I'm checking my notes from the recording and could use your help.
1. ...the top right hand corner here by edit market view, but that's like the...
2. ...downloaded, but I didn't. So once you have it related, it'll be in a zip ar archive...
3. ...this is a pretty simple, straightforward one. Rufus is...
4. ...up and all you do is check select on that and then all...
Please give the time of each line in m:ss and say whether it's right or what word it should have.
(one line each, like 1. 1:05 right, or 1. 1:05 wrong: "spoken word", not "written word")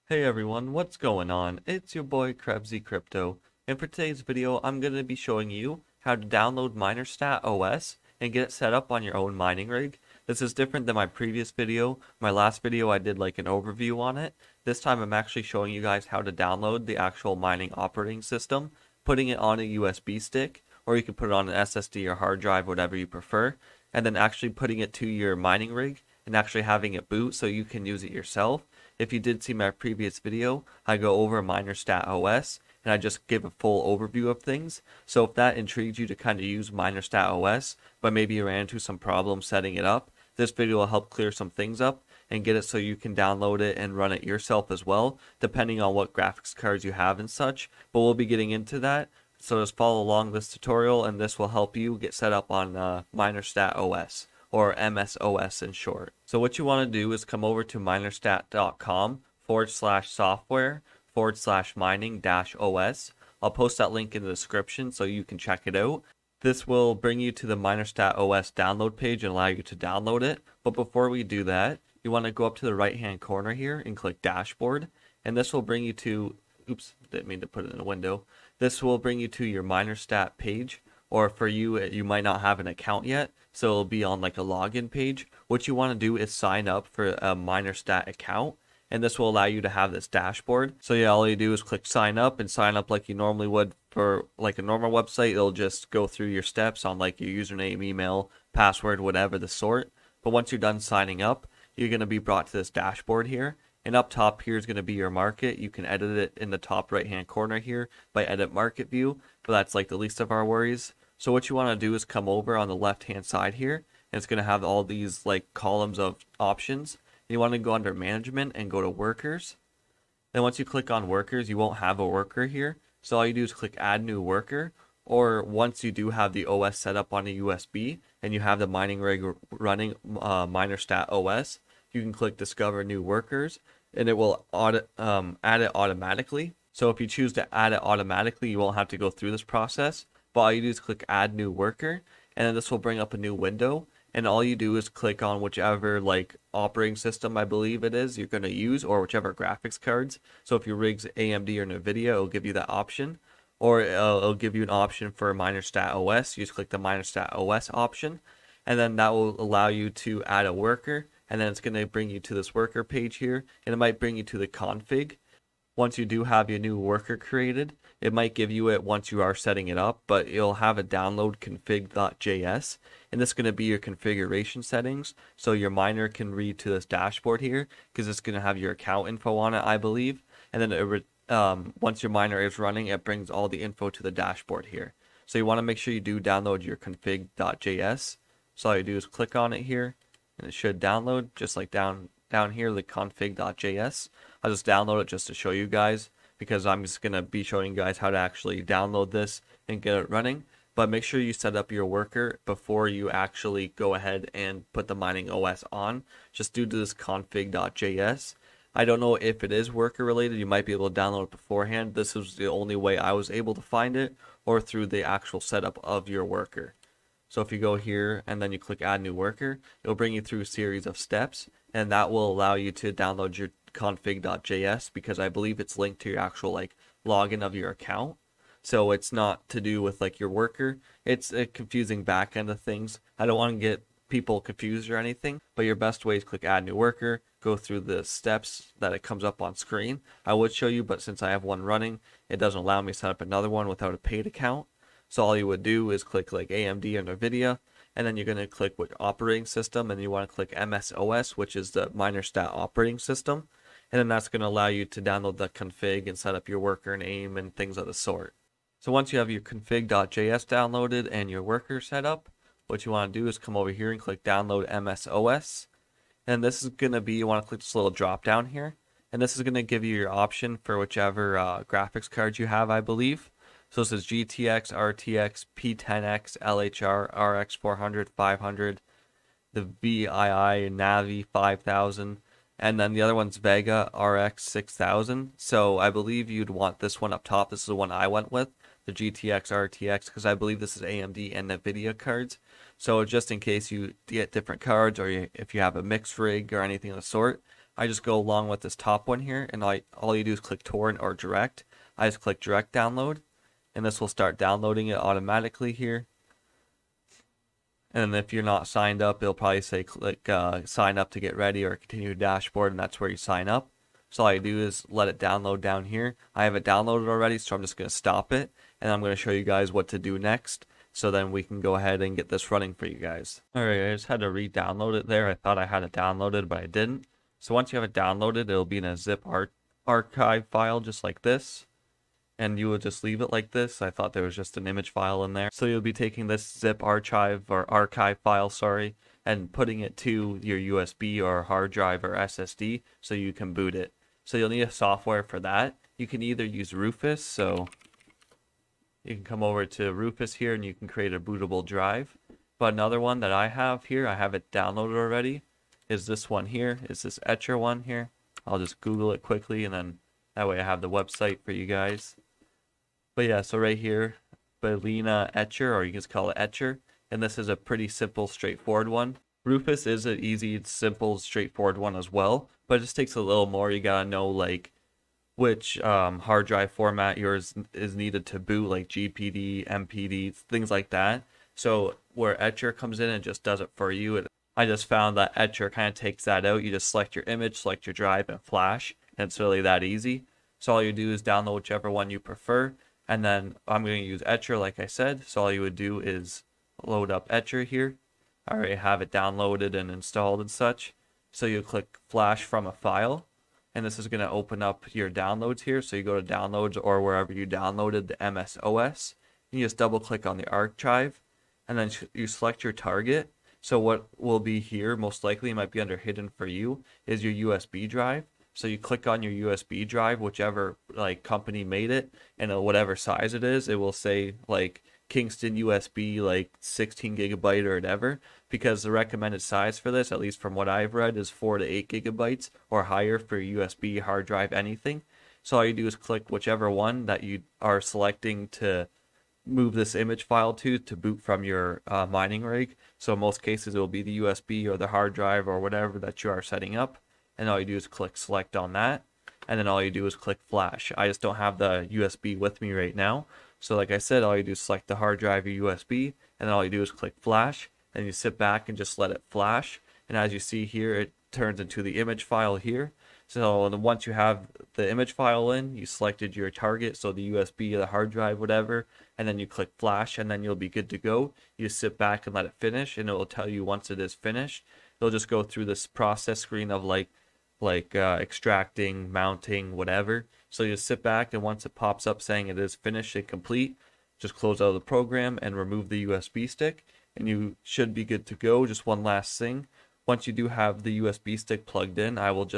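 1. 1:46 right
2. 5:25 wrong: "downloaded", not "related"
3. 6:07 right
4. 7:26 wrong: "click", not "check".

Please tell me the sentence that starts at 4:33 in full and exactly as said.
So this is GTX, RTX, P10X, LHR, RX400, 500, the VII, Navi 5000, and then the other one's Vega RX 6000.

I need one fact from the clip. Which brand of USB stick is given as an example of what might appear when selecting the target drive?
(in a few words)
Kingston.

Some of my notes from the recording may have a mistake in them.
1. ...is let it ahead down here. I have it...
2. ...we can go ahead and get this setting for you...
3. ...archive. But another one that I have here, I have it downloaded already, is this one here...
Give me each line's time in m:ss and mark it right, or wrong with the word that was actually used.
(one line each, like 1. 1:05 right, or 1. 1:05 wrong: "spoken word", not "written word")
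1. 5:14 wrong: "download", not "ahead"
2. 5:21 wrong: "running", not "setting"
3. 5:51 wrong: "drive", not "archive".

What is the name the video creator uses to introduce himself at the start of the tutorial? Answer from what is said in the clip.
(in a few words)
Krebsey Crypto.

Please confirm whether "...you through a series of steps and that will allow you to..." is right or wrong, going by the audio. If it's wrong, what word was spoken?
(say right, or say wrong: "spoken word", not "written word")
right.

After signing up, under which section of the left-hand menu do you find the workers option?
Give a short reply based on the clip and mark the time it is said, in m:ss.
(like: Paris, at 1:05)
management, at 1:57.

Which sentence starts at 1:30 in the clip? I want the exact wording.
So yeah, all you do is click sign up and sign up like you normally would for like a normal website.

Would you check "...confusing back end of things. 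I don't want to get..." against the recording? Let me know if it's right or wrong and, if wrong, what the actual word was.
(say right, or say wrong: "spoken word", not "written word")
right.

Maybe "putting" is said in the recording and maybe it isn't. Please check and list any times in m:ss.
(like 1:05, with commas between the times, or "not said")
0:19, 0:24, 5:39.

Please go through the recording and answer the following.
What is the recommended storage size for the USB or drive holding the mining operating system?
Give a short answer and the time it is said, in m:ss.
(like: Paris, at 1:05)
4 to 8 gigabytes, at 7:11.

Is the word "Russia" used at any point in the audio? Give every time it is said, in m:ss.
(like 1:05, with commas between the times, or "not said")
not said.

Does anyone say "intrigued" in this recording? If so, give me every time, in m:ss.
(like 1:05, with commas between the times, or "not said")
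0:35.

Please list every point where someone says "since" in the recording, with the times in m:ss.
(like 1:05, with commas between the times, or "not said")
4:01.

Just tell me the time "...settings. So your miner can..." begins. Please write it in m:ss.
2:54.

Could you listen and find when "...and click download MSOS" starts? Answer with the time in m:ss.
4:23.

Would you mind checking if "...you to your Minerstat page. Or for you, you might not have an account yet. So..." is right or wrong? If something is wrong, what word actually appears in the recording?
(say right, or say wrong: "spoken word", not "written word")
right.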